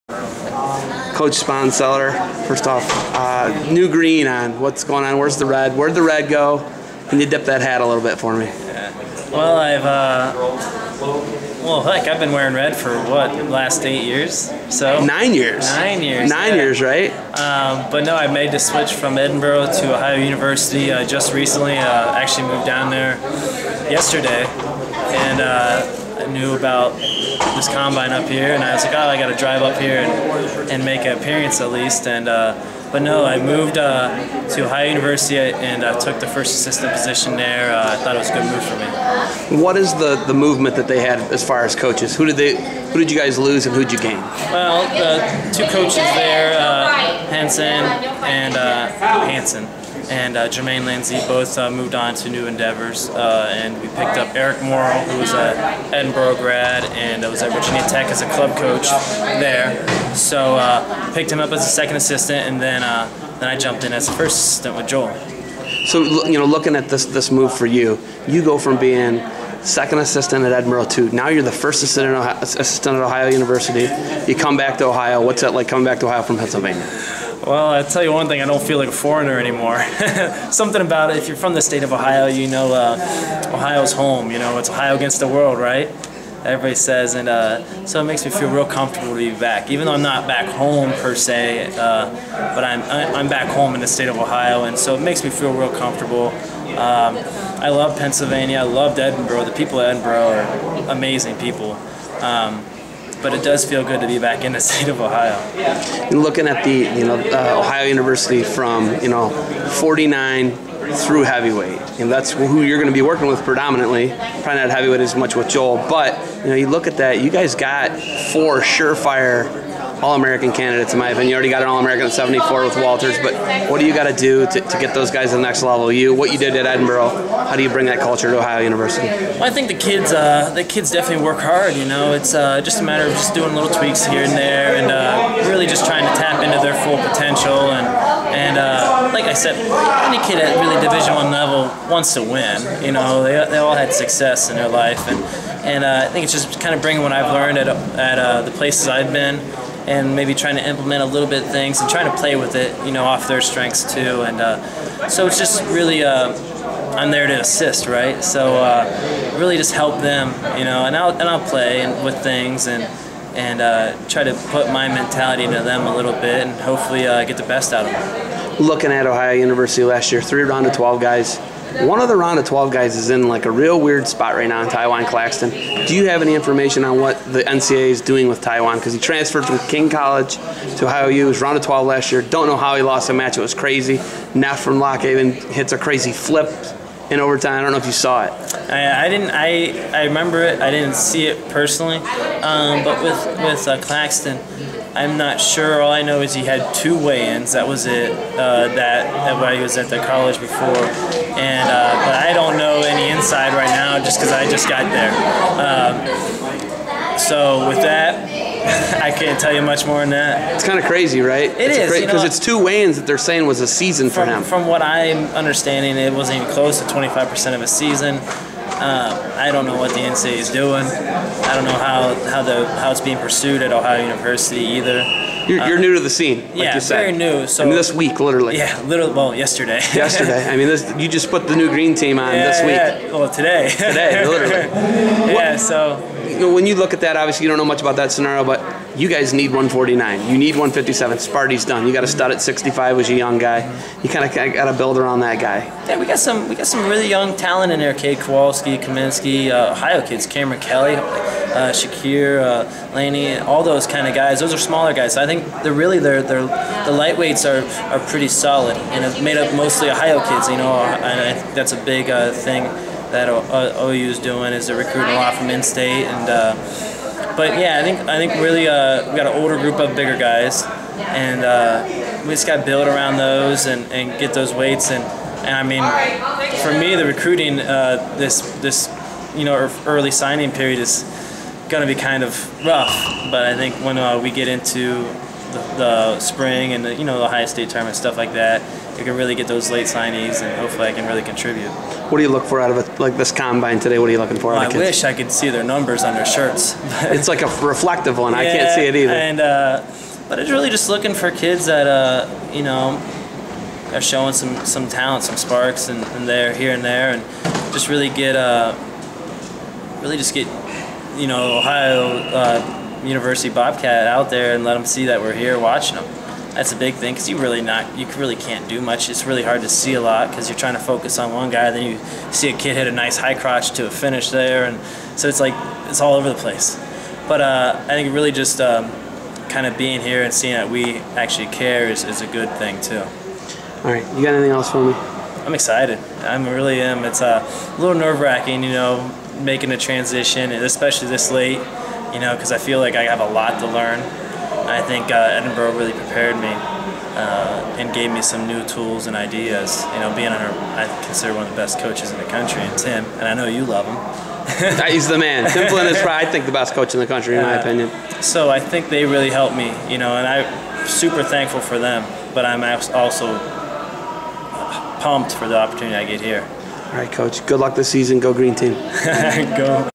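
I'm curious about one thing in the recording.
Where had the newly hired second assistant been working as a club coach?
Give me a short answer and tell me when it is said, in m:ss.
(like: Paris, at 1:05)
Virginia Tech, at 0:57.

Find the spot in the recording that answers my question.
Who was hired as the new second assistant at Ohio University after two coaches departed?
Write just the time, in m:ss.
0:54.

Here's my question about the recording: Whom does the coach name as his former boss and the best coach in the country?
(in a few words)
Tim Flynn.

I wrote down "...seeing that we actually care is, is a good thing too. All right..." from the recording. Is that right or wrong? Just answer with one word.
right.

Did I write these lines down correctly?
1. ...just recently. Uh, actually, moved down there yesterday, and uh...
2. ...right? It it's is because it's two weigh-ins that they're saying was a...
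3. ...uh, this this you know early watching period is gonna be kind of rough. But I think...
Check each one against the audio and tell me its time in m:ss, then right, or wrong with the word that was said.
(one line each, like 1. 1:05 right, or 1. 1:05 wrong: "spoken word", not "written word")
1. 0:21 right
2. 3:31 right
3. 4:37 wrong: "signing", not "watching".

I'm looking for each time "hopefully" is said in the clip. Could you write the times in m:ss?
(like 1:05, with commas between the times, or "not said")
2:46, 4:50.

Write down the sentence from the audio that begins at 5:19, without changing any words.
It's really hard to see a lot because you're trying to focus on one guy.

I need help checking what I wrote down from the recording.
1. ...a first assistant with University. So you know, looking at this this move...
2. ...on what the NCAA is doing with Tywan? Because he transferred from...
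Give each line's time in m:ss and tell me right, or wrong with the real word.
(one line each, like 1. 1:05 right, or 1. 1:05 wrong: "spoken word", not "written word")
1. 1:04 wrong: "Joel", not "University"
2. 2:56 right.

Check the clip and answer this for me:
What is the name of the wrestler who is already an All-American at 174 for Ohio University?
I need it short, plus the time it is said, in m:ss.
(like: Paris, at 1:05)
Walters, at 2:02.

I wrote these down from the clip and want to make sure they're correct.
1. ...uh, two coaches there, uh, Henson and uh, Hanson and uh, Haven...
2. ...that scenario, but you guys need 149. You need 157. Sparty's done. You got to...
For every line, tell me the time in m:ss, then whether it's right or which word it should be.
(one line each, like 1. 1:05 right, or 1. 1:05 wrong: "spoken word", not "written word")
1. 0:44 wrong: "Jermaine", not "Haven"
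2. 3:57 right.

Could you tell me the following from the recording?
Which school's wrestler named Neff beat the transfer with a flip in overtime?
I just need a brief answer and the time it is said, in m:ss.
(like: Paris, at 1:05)
Lock Haven, at 3:04.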